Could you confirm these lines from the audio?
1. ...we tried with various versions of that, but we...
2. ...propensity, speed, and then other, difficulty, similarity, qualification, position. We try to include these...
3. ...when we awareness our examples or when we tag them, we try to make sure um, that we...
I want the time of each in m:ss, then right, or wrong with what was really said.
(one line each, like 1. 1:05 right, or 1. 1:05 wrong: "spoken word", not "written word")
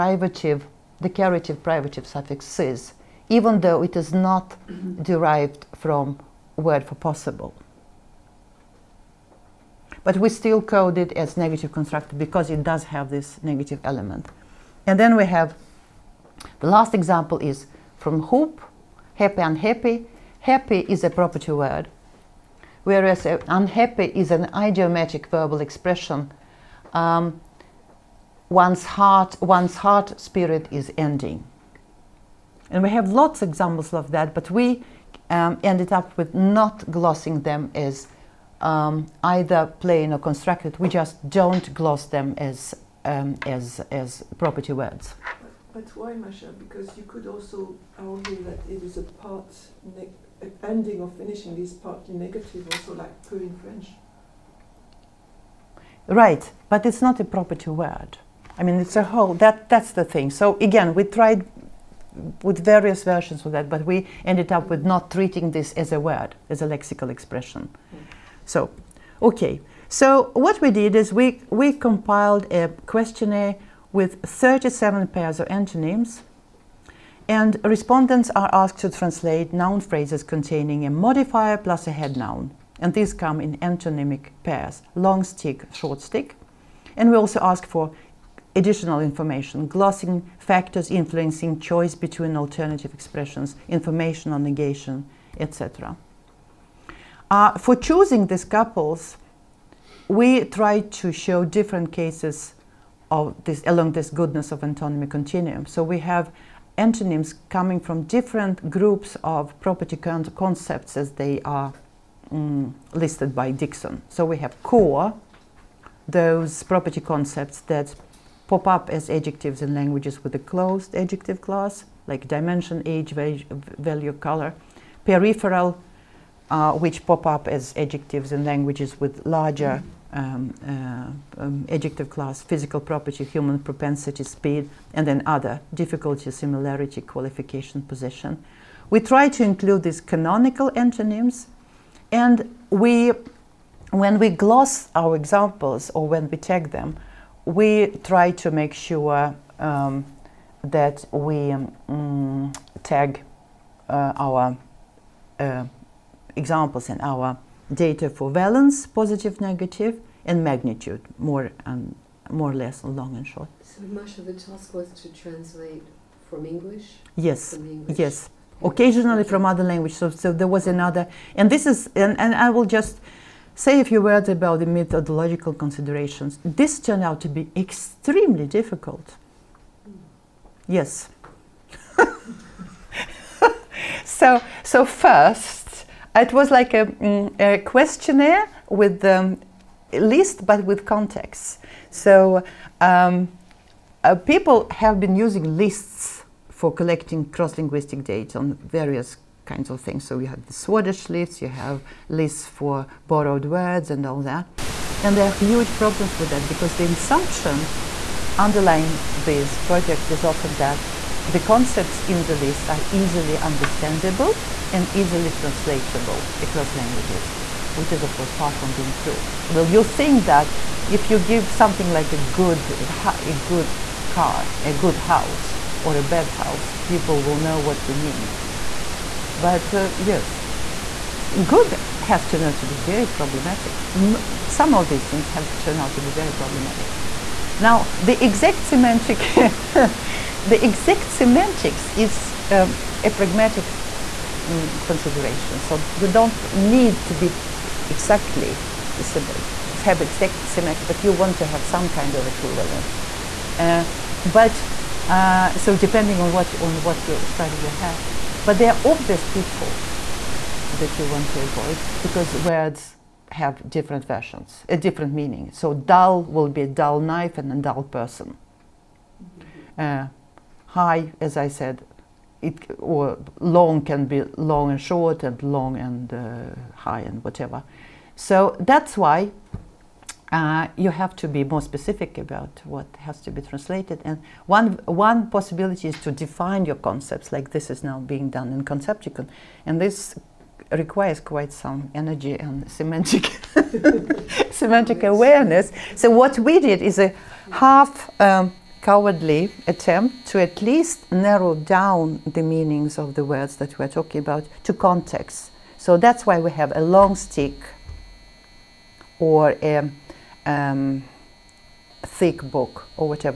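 1. 1:00 right
2. 2:13 right
3. 2:23 wrong: "gloss", not "awareness".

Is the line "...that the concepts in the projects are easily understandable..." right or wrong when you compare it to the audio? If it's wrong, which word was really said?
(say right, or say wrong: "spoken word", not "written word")
wrong: "lists", not "projects".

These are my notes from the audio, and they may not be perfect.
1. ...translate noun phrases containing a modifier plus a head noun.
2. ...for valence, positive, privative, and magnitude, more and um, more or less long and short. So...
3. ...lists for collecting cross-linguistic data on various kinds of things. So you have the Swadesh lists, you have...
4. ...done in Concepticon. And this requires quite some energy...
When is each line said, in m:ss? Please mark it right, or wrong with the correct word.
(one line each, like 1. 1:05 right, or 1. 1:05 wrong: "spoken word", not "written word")
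1. 1:18 right
2. 2:38 wrong: "negative", not "privative"
3. 3:15 right
4. 4:48 right.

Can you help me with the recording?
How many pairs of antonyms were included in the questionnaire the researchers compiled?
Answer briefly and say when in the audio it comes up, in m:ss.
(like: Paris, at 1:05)
37, at 1:14.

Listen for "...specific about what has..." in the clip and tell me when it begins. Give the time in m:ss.
4:41.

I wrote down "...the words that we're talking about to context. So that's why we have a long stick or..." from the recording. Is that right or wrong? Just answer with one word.
right.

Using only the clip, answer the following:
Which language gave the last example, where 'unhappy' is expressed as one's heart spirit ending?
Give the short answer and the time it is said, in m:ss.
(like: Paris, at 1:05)
Hup, at 0:18.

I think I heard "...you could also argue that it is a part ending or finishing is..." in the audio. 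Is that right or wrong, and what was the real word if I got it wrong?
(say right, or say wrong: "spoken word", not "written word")
right.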